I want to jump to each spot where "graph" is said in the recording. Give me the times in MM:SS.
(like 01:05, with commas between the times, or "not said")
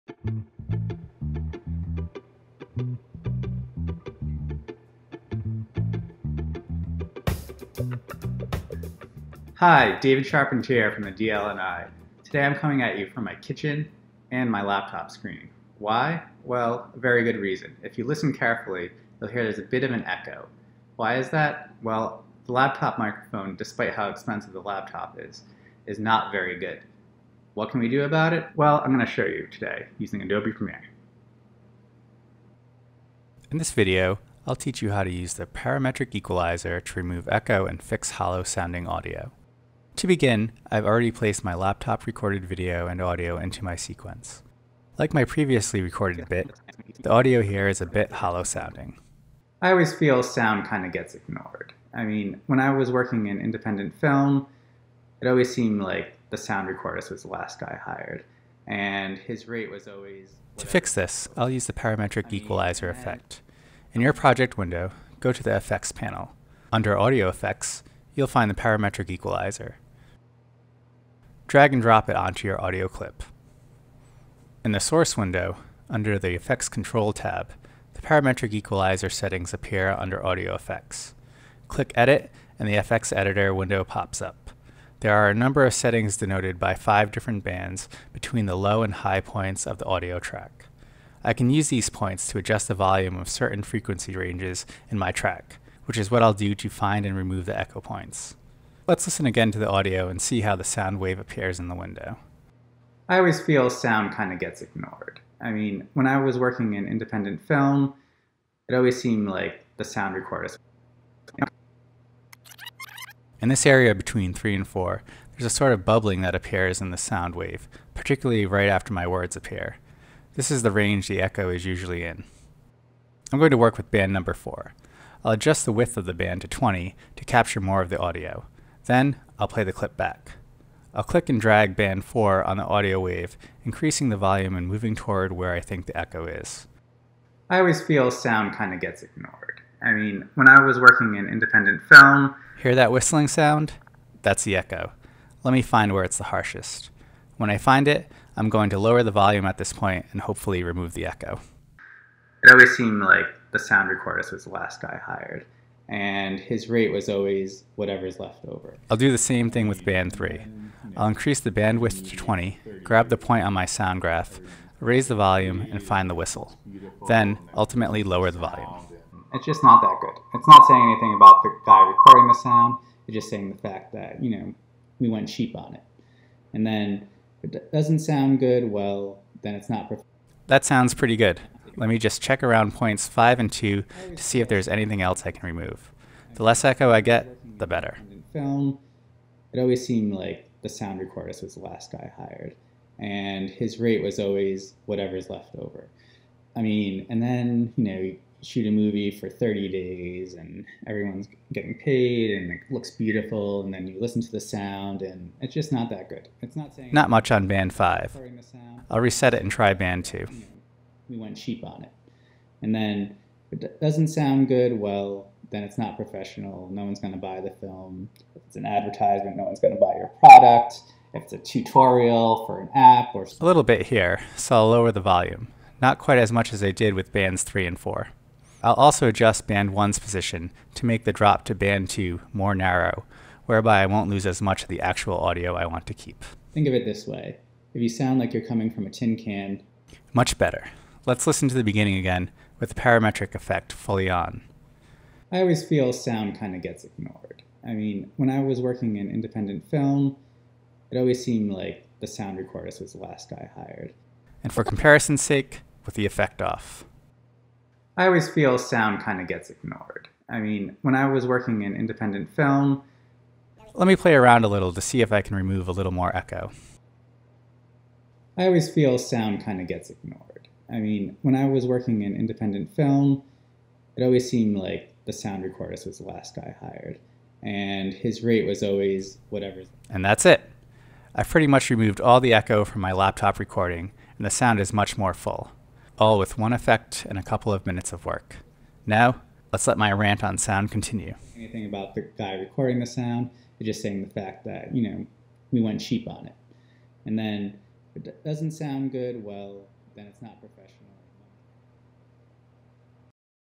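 02:44.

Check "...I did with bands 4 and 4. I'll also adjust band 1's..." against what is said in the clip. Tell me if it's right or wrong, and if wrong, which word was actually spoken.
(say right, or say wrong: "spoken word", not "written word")
wrong: "3", not "4".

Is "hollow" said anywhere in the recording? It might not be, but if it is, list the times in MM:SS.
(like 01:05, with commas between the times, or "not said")
00:38, 00:48.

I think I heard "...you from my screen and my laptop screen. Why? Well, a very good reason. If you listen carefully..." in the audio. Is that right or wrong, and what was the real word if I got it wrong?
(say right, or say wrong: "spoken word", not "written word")
wrong: "kitchen", not "screen".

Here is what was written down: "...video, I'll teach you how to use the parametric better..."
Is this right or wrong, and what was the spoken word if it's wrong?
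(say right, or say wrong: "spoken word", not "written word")
wrong: "equalizer", not "better".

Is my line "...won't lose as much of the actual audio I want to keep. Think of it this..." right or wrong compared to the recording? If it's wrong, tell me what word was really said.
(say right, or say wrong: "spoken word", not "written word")
right.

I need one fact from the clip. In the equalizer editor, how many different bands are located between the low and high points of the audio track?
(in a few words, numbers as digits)
5.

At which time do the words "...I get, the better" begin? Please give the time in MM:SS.
03:06.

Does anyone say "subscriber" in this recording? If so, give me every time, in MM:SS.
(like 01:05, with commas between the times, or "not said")
not said.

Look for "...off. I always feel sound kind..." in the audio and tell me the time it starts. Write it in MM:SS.
04:16.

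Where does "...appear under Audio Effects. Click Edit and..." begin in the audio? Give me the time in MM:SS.
01:19.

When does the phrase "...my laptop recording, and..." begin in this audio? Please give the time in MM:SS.
04:42.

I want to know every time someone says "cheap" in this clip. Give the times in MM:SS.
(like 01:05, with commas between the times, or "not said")
02:55, 03:31, 04:55.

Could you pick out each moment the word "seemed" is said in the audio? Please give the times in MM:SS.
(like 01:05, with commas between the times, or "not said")
00:55, 01:49, 02:32, 03:09, 04:11, 04:34.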